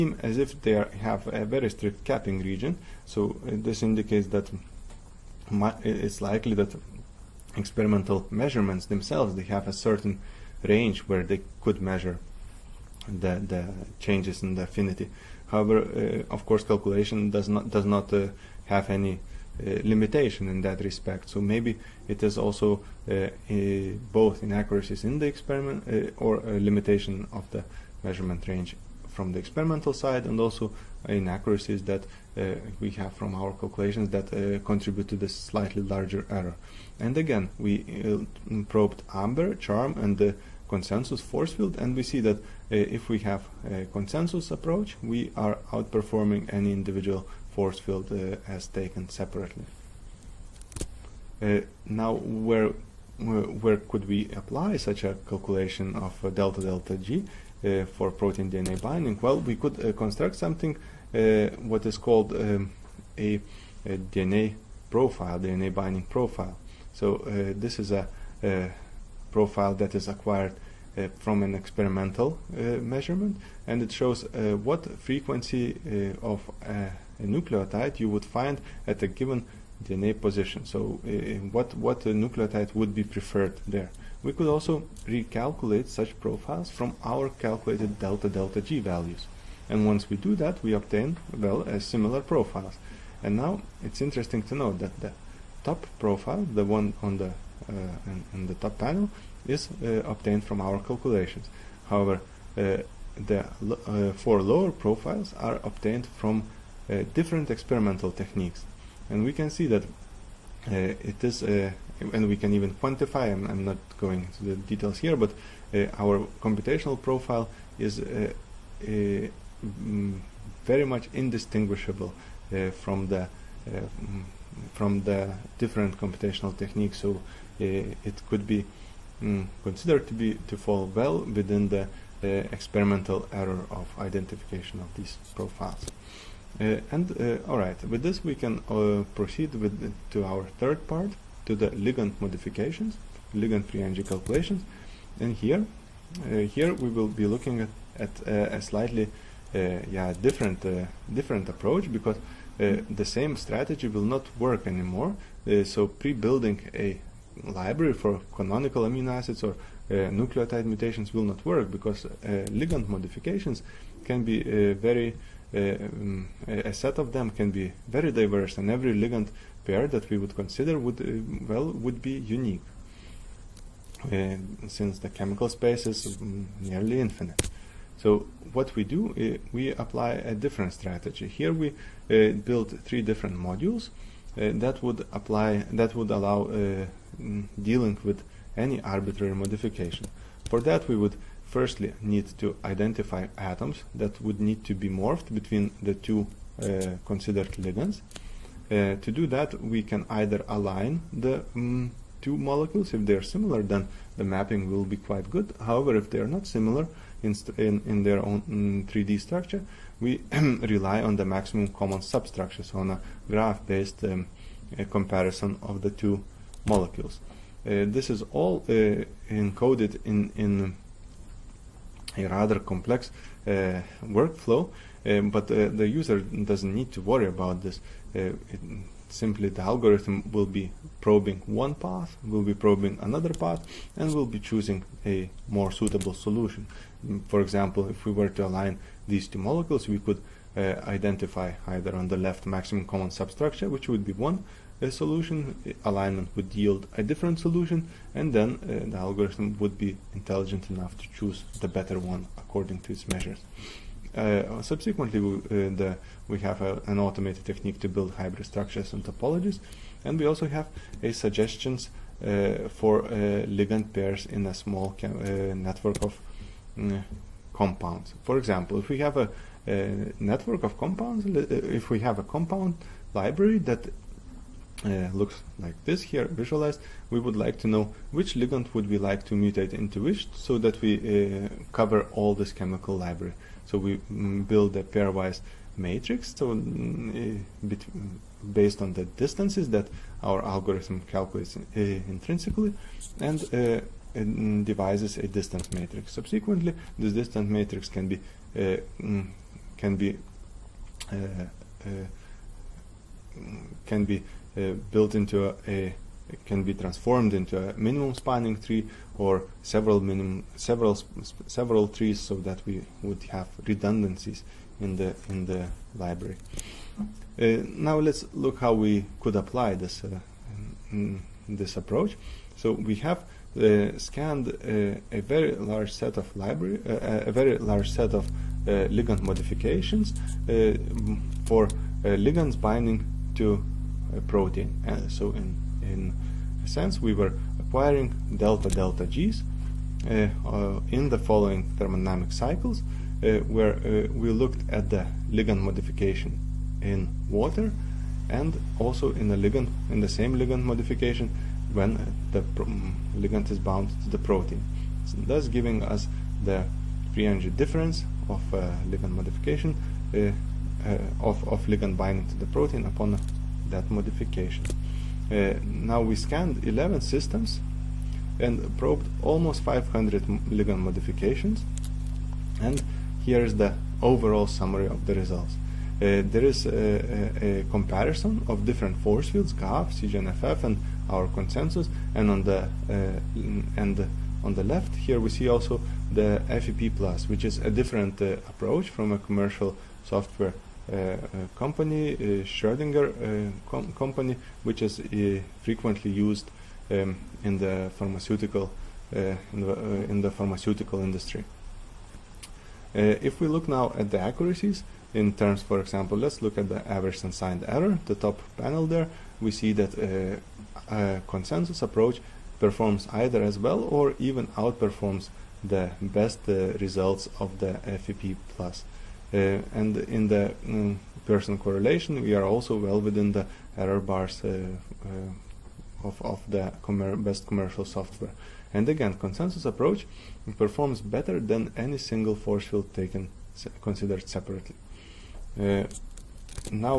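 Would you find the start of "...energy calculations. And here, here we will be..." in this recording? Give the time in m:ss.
2:23.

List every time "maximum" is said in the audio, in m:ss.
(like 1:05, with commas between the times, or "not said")
3:31, 4:02.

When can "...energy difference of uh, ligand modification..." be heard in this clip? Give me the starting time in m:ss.
5:57.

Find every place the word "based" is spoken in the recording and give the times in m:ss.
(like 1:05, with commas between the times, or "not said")
3:33, 4:48.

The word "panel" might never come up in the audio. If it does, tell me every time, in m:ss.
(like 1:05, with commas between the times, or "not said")
1:38, 6:48.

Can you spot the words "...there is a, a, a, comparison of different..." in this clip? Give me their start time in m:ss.
6:16.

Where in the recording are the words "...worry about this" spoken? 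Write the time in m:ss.
3:47.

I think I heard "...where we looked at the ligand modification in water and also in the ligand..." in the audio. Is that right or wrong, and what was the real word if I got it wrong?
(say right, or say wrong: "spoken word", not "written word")
right.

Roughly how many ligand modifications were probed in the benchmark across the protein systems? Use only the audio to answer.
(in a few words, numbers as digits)
almost 500.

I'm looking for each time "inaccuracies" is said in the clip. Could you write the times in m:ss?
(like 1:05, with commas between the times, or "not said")
0:24, 0:31.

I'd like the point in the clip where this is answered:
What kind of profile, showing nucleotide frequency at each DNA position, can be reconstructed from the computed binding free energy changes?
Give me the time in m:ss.
1:05.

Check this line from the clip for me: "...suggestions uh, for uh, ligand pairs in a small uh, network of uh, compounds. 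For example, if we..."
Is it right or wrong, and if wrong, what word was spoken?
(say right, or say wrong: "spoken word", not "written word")
right.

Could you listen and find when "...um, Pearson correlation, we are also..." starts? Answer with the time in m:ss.
7:00.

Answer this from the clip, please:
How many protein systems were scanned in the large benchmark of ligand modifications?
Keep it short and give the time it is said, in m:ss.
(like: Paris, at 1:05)
11, at 6:06.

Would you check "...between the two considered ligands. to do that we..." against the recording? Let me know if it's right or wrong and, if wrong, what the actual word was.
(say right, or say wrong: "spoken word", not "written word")
right.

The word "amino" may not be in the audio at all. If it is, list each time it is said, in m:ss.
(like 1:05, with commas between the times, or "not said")
2:38.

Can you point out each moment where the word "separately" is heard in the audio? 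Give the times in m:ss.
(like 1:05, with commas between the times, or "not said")
0:49, 7:14.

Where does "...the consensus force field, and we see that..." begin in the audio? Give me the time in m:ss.
0:40.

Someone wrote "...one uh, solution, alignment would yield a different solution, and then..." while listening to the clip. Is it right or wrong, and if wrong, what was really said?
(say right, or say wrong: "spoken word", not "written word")
right.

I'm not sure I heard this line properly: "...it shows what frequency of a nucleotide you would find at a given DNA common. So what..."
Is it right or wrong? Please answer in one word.
wrong.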